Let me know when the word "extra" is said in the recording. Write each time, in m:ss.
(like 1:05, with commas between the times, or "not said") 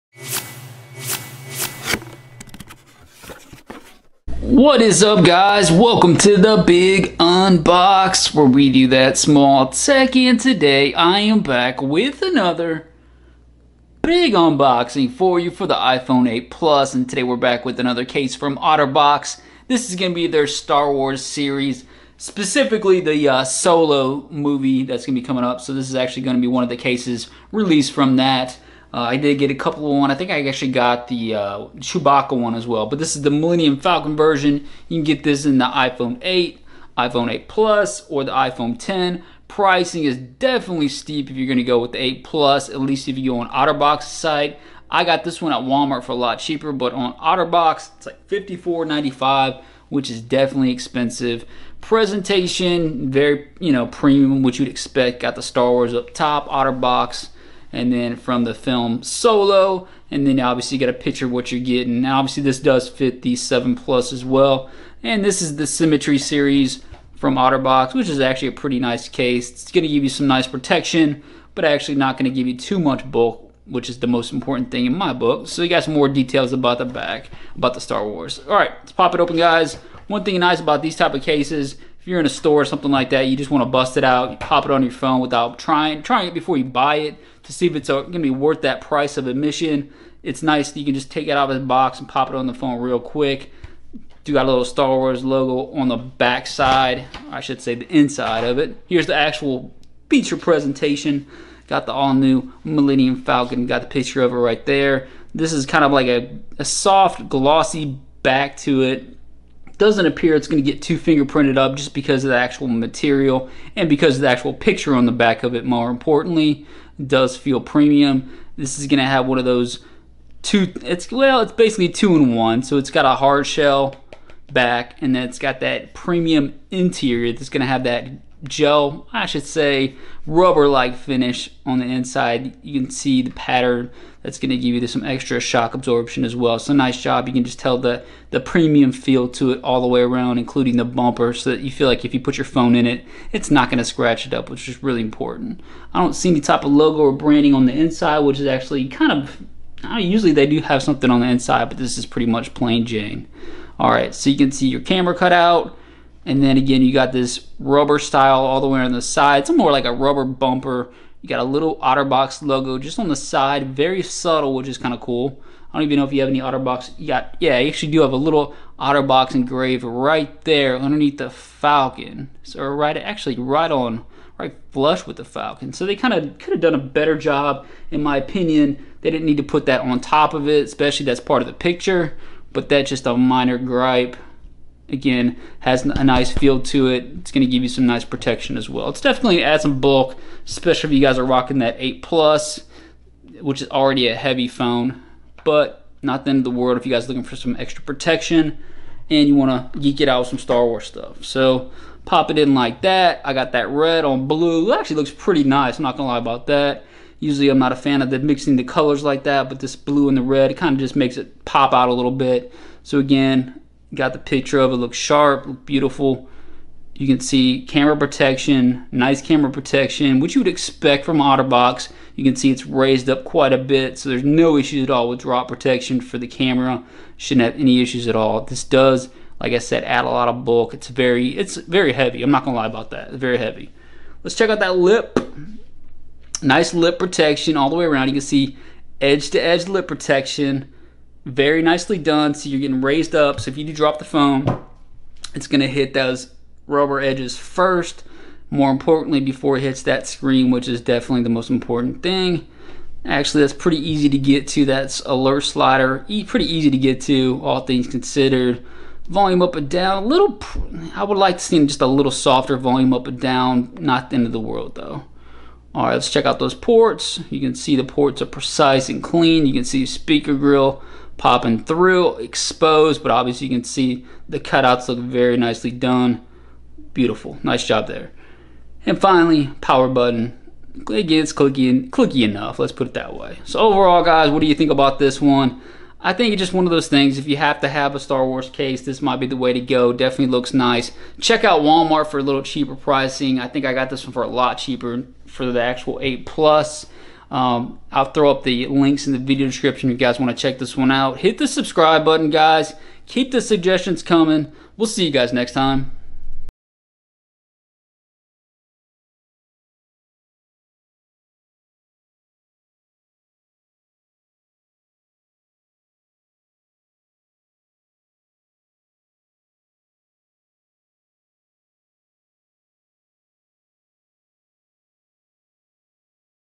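2:15, 3:17.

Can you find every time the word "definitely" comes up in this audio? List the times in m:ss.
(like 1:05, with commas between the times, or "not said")
0:40, 0:50, 3:09, 4:10, 4:49.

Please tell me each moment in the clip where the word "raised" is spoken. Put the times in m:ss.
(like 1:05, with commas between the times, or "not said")
3:42, 4:02.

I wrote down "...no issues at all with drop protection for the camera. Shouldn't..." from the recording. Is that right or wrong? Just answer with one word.
right.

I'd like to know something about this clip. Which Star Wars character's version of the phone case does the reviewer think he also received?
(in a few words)
Chewbacca.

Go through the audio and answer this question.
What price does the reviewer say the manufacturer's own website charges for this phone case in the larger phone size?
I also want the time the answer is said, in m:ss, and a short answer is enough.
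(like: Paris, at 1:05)
$54.95, at 0:48.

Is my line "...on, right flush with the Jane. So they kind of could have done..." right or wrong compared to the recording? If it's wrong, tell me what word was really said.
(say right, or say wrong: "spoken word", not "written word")
wrong: "Falcon", not "Jane".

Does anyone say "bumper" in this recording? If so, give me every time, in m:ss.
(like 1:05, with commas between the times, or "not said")
2:20, 2:40.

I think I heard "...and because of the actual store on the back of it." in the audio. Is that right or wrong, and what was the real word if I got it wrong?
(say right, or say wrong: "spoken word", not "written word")
wrong: "picture", not "store".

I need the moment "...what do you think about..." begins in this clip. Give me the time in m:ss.
4:44.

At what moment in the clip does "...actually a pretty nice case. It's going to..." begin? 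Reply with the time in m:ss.
1:08.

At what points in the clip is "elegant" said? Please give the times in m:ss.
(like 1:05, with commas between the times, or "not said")
not said.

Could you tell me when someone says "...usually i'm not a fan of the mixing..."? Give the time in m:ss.
3:27.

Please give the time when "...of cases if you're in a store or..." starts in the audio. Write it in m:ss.
1:21.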